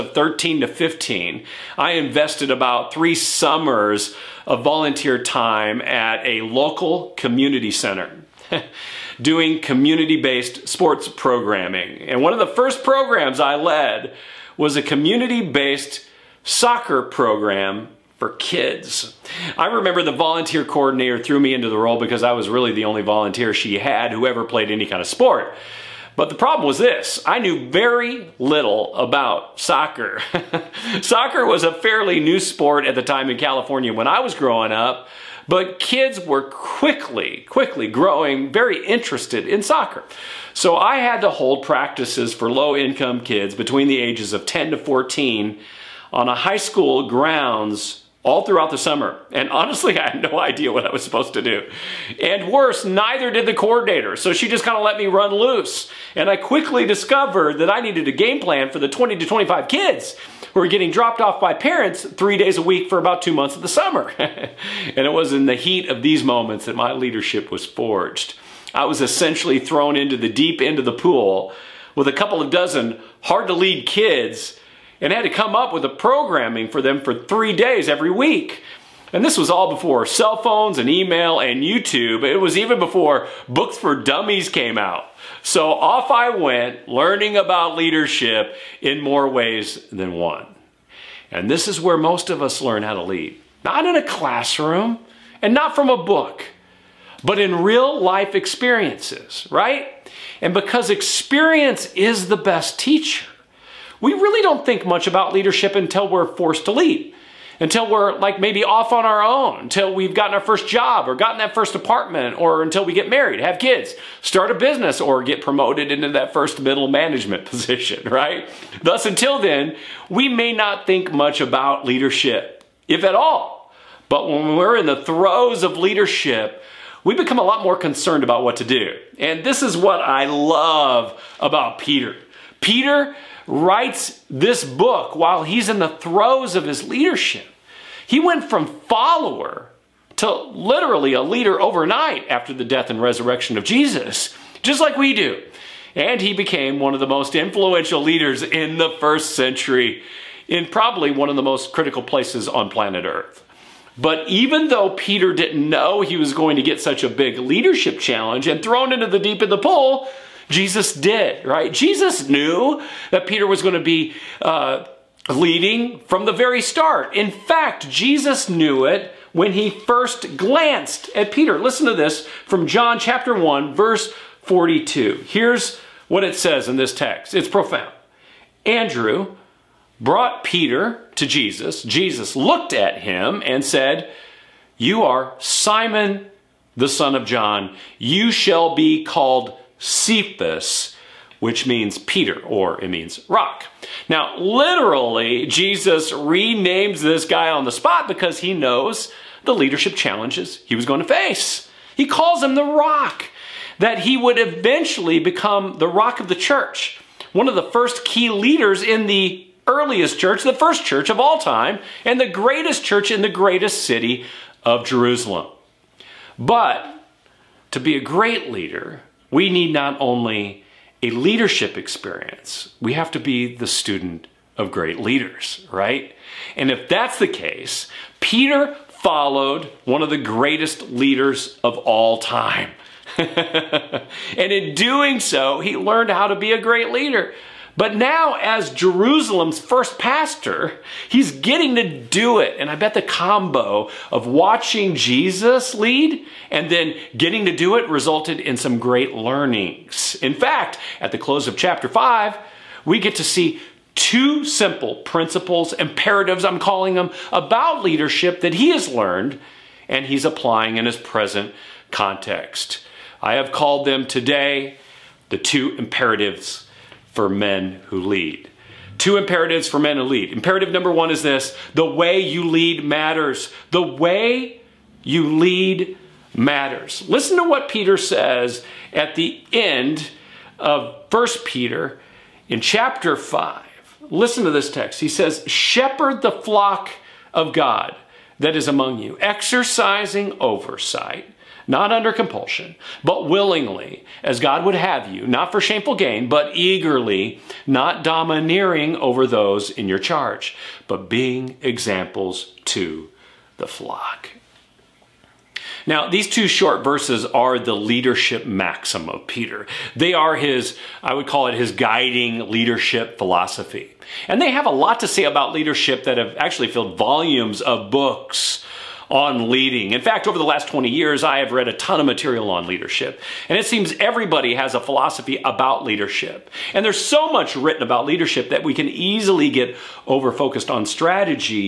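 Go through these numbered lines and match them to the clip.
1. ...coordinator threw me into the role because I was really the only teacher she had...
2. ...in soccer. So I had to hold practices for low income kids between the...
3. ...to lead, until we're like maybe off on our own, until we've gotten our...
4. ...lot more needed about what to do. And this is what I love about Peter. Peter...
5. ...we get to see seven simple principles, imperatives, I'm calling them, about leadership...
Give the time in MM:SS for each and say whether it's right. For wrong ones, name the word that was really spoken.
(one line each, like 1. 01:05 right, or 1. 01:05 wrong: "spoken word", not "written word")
1. 00:20 wrong: "volunteer", not "teacher"
2. 00:39 right
3. 01:46 right
4. 02:07 wrong: "concerned", not "needed"
5. 04:12 wrong: "two", not "seven".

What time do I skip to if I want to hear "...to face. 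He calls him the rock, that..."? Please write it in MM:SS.
03:20.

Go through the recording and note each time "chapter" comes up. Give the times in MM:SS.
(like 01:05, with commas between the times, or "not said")
02:52, 04:11, 04:42.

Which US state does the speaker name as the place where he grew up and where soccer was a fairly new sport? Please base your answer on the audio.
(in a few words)
California.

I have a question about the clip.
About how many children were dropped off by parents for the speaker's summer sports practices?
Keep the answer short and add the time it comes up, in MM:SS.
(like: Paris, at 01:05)
20 to 25, at 00:58.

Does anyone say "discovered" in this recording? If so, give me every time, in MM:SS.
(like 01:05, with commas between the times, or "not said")
00:56.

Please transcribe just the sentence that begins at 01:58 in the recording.
Thus, until then, we may not think much about leadership, if at all.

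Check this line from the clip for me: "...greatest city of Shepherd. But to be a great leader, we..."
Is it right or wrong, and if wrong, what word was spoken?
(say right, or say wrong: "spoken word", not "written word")
wrong: "Jerusalem", not "Shepherd".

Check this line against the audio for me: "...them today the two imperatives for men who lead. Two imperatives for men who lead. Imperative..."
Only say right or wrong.
right.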